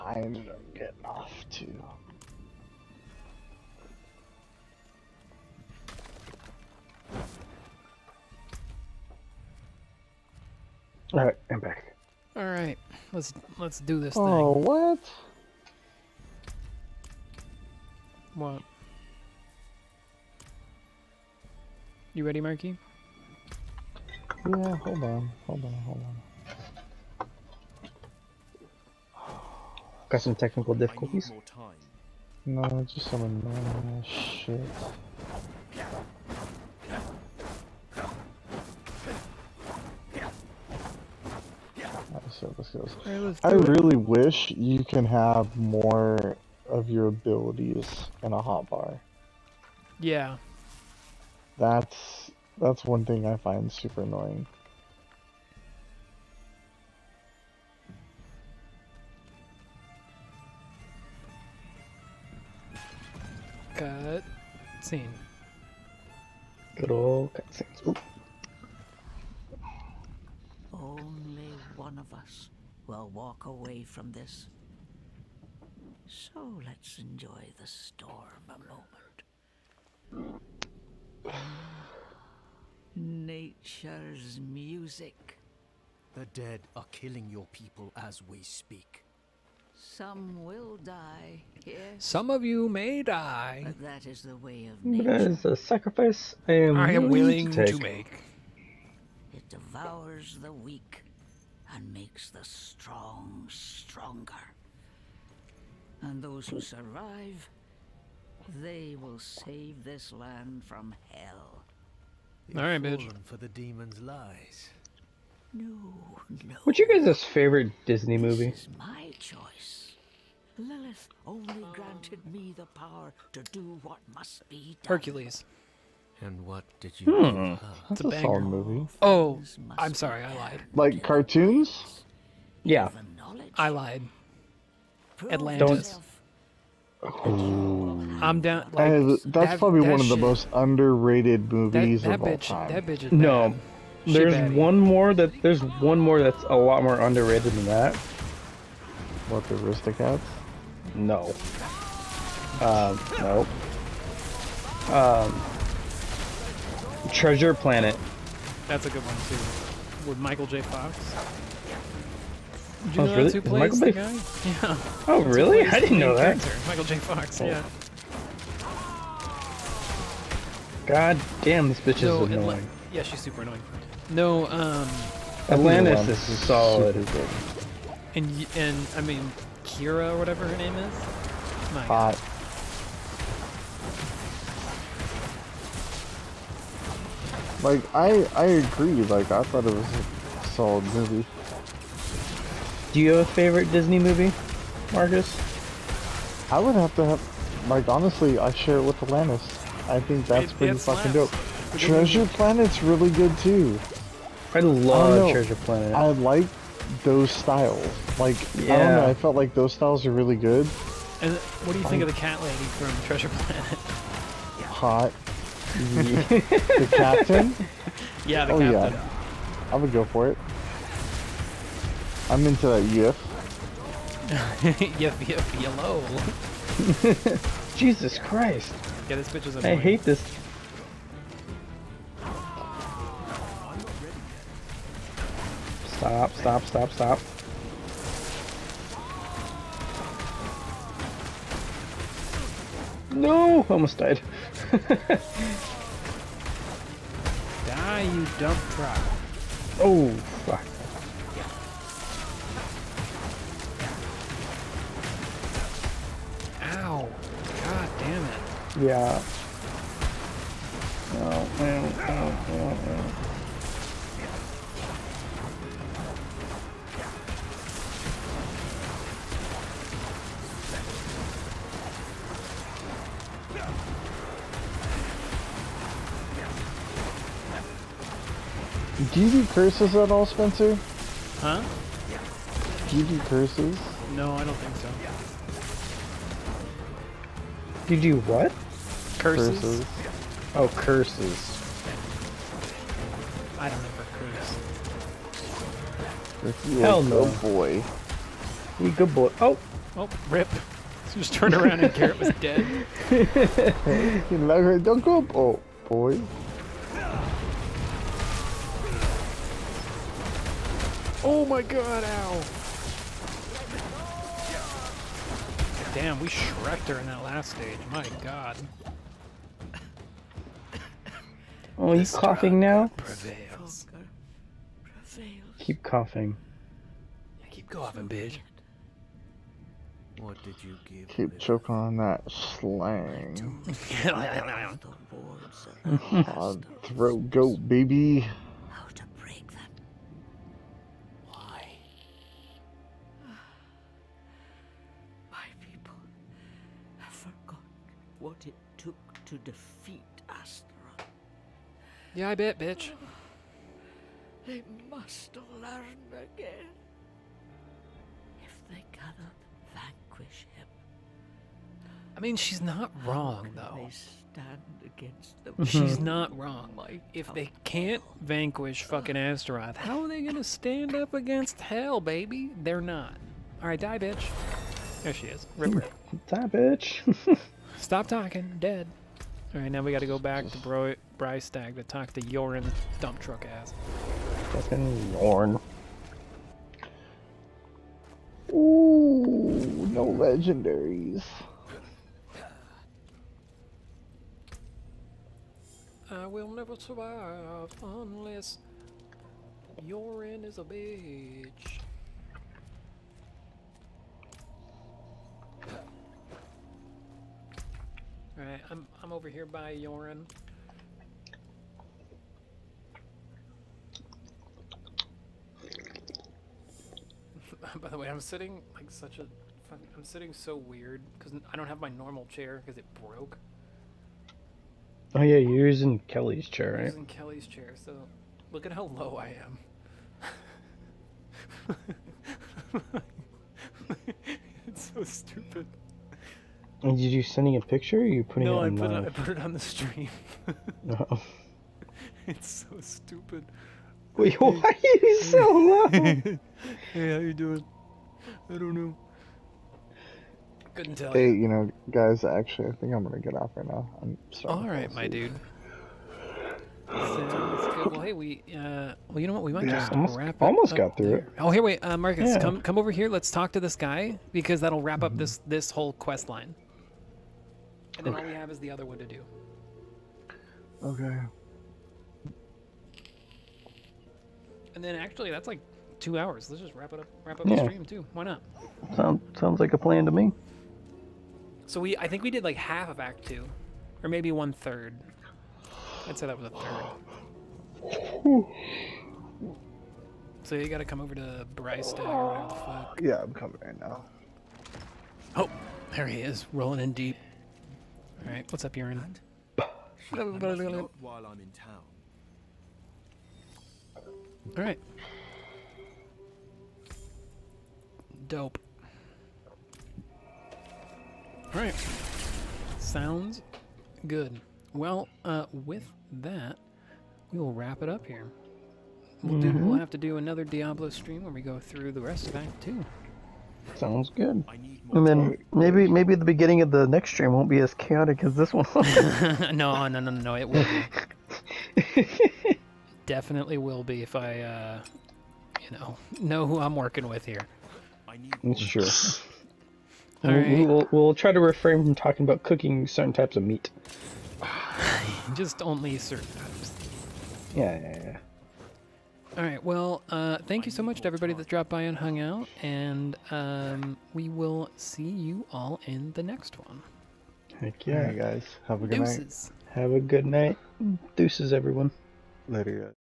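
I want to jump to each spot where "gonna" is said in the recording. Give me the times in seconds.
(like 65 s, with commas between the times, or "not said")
370 s, 453 s.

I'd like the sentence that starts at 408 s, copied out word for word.
Alright, I'm, I'm over here by Yorin.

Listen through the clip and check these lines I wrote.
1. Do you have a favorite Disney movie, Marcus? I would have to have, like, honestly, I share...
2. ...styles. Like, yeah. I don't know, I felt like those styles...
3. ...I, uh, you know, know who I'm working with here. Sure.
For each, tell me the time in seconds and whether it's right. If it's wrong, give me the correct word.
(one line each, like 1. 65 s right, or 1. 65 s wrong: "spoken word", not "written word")
1. 192 s right
2. 207 s right
3. 534 s right.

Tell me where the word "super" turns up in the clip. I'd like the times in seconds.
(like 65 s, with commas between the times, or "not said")
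53 s, 173 s.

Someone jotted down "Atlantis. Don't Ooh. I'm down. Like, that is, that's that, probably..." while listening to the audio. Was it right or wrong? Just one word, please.
right.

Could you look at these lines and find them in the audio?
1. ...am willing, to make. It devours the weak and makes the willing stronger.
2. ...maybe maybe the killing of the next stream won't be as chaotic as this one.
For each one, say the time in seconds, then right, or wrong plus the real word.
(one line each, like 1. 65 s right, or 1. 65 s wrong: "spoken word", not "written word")
1. 96 s wrong: "strong", not "willing"
2. 525 s wrong: "beginning", not "killing".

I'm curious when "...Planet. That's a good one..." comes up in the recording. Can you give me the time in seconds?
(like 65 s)
157 s.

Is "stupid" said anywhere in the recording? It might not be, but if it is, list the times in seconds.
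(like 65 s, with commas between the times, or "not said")
435 s, 442 s.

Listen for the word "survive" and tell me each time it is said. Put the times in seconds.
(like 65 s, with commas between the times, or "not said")
106 s, 396 s.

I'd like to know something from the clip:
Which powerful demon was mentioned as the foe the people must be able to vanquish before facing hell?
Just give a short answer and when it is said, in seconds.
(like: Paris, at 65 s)
Astaroth, at 369 s.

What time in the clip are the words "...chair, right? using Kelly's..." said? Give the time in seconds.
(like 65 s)
426 s.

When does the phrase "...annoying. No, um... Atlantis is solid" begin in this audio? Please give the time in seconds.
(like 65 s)
173 s.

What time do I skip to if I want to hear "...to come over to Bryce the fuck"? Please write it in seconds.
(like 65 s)
490 s.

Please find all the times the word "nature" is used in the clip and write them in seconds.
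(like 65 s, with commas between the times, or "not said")
82 s, 94 s.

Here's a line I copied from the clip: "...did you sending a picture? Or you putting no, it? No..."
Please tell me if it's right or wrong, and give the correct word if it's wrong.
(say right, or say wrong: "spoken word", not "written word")
right.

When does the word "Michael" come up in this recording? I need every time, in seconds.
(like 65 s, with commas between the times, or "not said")
160 s, 166 s.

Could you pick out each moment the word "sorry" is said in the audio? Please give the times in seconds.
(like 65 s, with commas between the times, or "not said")
129 s, 454 s.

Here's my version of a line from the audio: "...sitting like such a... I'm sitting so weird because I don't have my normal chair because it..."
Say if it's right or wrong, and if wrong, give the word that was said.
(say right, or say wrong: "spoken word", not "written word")
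right.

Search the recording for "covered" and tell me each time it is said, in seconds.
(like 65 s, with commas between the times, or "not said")
not said.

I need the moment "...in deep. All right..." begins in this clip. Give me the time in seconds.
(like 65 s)
496 s.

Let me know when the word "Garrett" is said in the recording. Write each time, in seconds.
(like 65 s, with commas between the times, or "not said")
301 s.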